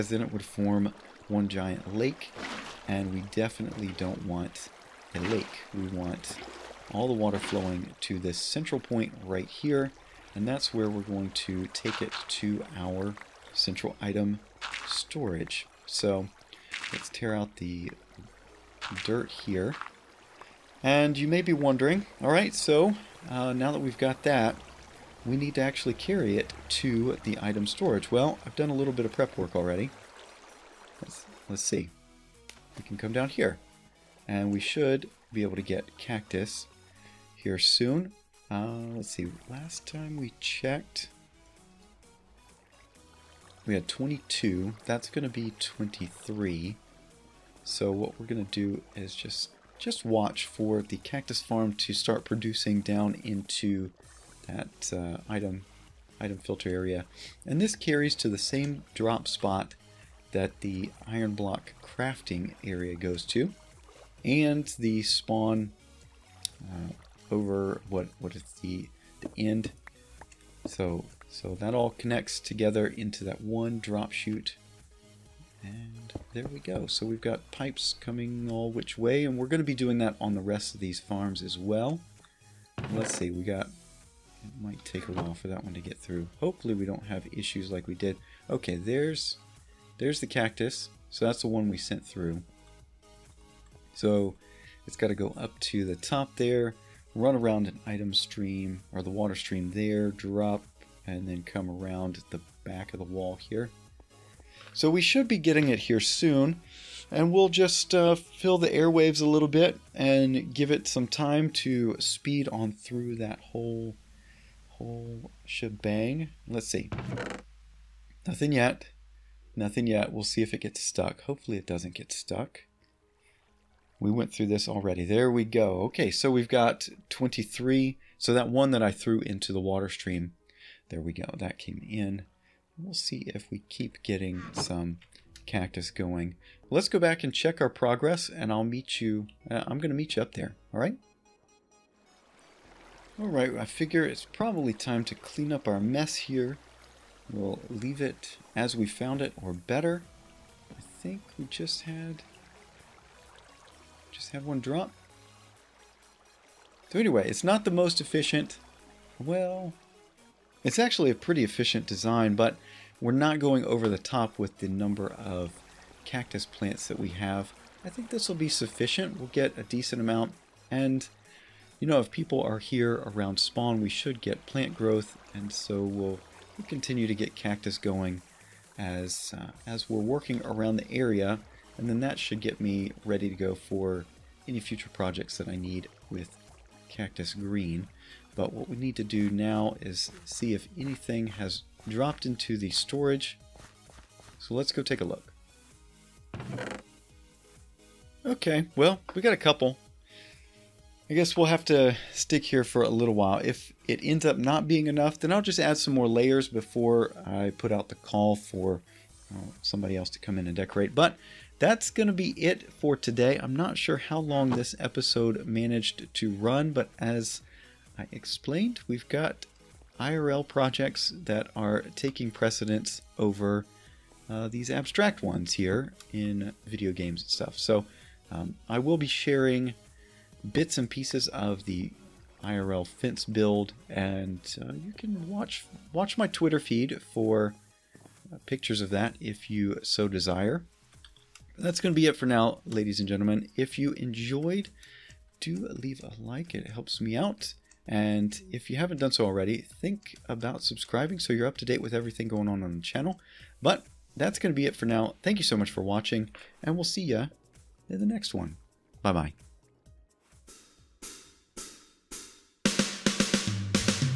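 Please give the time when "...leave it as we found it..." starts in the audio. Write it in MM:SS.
02:27.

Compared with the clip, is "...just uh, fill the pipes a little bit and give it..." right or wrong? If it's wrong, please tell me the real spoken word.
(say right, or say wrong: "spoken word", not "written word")
wrong: "airwaves", not "pipes".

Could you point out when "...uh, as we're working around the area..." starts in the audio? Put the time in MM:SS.
02:59.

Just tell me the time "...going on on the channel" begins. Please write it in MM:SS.
04:12.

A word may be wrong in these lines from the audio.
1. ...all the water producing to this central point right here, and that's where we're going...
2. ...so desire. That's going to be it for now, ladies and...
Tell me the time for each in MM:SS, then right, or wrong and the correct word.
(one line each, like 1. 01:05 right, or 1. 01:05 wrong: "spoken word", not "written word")
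1. 00:06 wrong: "flowing", not "producing"
2. 03:59 right.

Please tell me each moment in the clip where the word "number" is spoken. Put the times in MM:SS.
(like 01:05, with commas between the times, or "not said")
02:44.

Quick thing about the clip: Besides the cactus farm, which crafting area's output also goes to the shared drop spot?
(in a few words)
iron block.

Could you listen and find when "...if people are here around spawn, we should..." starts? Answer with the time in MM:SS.
02:51.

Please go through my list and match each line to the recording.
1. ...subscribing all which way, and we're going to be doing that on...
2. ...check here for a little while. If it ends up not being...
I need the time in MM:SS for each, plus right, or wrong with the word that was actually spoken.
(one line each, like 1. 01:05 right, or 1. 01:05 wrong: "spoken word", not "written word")
1. 01:17 wrong: "coming", not "subscribing"
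2. 03:22 wrong: "stick", not "check".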